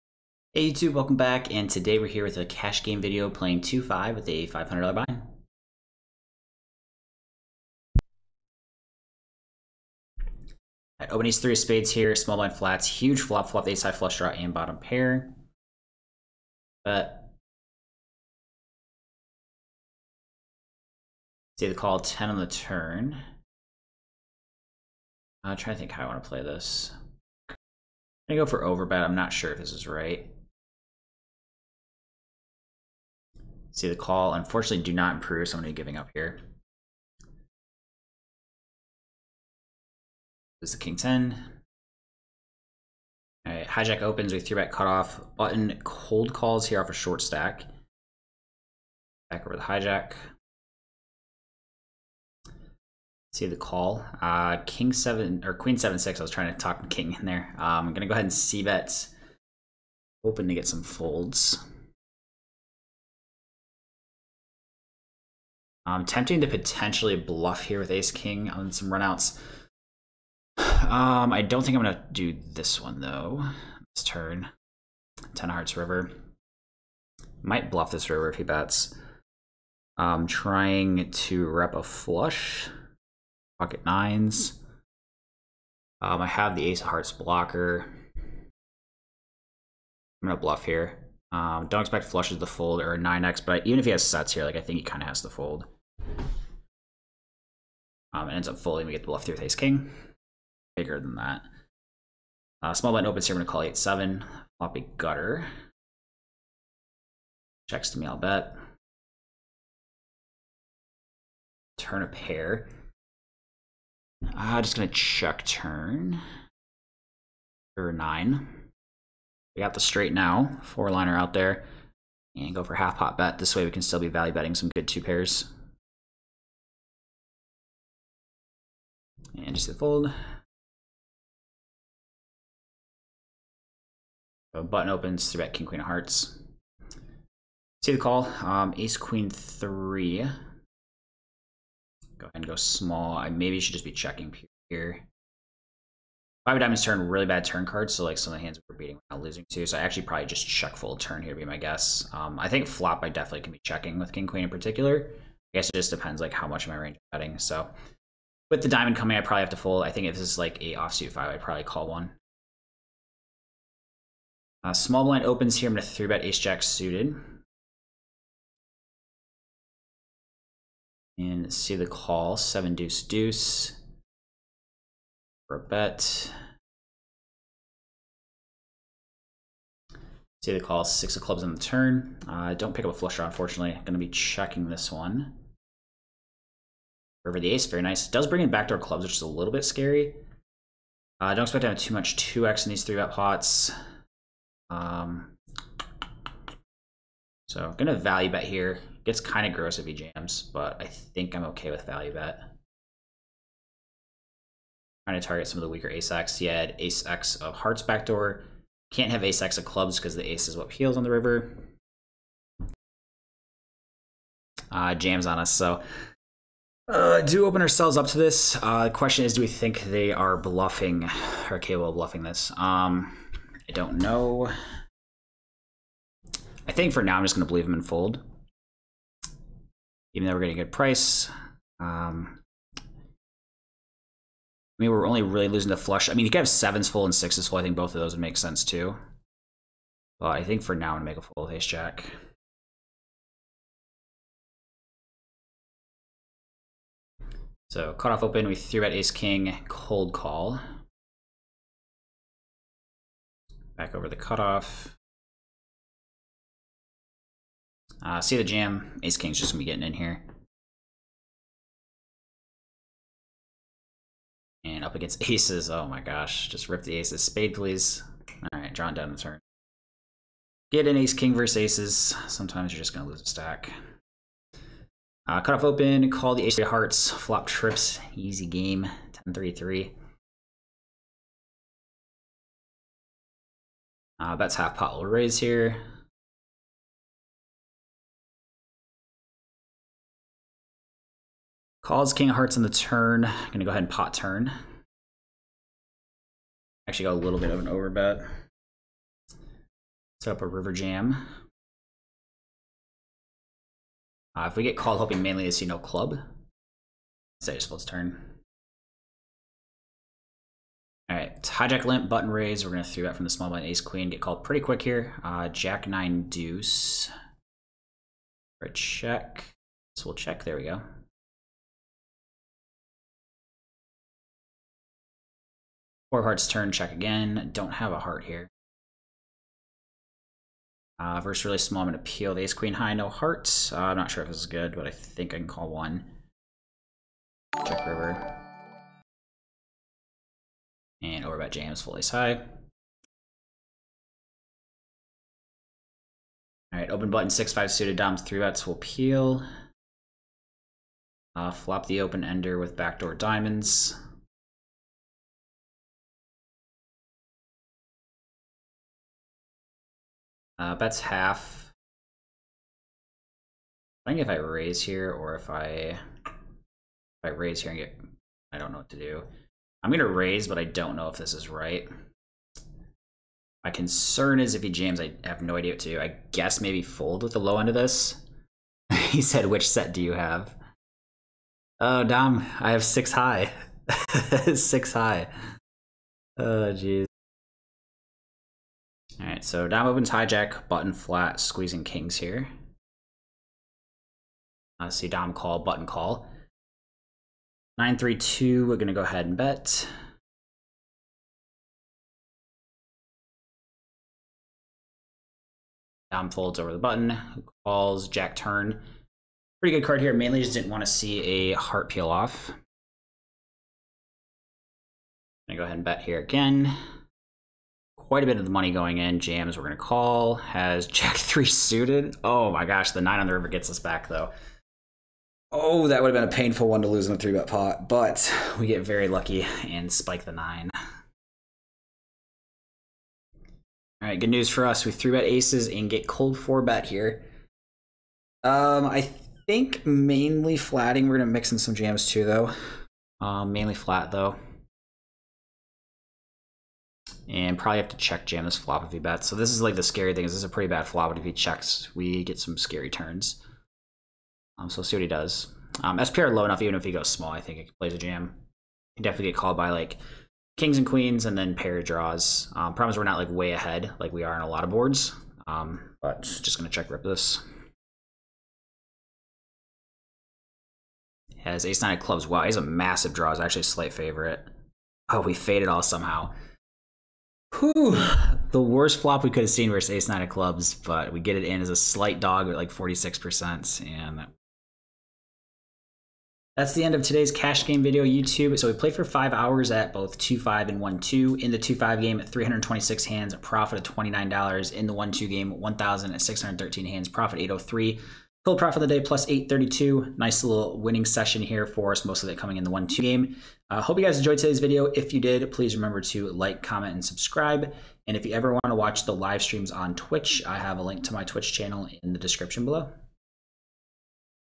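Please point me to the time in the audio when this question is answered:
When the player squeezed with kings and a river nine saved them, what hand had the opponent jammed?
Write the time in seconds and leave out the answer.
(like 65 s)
420 s.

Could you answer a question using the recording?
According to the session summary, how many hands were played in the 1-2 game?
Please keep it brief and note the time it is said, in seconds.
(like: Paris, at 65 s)
1,613, at 495 s.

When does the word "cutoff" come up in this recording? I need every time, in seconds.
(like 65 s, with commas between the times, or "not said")
44 s, 254 s.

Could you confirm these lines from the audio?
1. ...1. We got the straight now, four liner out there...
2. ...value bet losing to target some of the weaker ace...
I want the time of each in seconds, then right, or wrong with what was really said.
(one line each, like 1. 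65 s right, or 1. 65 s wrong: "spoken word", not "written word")
1. 117 s wrong: "9", not "1"
2. 201 s wrong: "trying", not "losing".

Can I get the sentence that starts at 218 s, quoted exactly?
Uh, the question is, do we think they are bluffing or capable of bluffing this?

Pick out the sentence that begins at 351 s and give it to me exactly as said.
Uh, flop the open ender with backdoor diamonds.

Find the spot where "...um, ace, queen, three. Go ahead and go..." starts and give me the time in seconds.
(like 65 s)
138 s.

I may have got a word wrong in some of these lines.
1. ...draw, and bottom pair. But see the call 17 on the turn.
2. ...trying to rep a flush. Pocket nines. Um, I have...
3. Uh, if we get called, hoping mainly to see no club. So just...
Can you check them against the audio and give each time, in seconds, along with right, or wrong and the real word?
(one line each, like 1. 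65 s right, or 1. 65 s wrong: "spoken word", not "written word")
1. 14 s wrong: "10", not "17"
2. 80 s right
3. 304 s right.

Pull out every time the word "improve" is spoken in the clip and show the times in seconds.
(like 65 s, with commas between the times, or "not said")
35 s.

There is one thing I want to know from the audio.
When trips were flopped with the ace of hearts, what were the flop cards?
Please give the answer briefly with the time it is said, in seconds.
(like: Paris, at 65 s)
10-3-3, at 279 s.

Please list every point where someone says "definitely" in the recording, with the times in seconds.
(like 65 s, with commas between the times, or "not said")
153 s, 459 s.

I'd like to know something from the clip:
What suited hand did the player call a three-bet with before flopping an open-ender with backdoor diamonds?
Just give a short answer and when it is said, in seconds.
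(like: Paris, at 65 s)
6-5 suited, at 347 s.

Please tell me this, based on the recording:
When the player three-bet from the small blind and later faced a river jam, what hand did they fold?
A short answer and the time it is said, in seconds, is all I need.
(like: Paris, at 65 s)
Ace jack suited, at 166 s.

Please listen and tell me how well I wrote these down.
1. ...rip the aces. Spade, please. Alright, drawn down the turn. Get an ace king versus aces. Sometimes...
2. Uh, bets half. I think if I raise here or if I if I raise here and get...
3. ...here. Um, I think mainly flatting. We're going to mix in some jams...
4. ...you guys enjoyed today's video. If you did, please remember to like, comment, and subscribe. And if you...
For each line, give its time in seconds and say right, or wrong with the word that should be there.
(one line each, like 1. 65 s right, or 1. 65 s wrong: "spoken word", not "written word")
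1. 266 s right
2. 360 s right
3. 436 s right
4. 503 s right.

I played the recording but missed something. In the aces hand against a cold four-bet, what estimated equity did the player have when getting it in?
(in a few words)
46%.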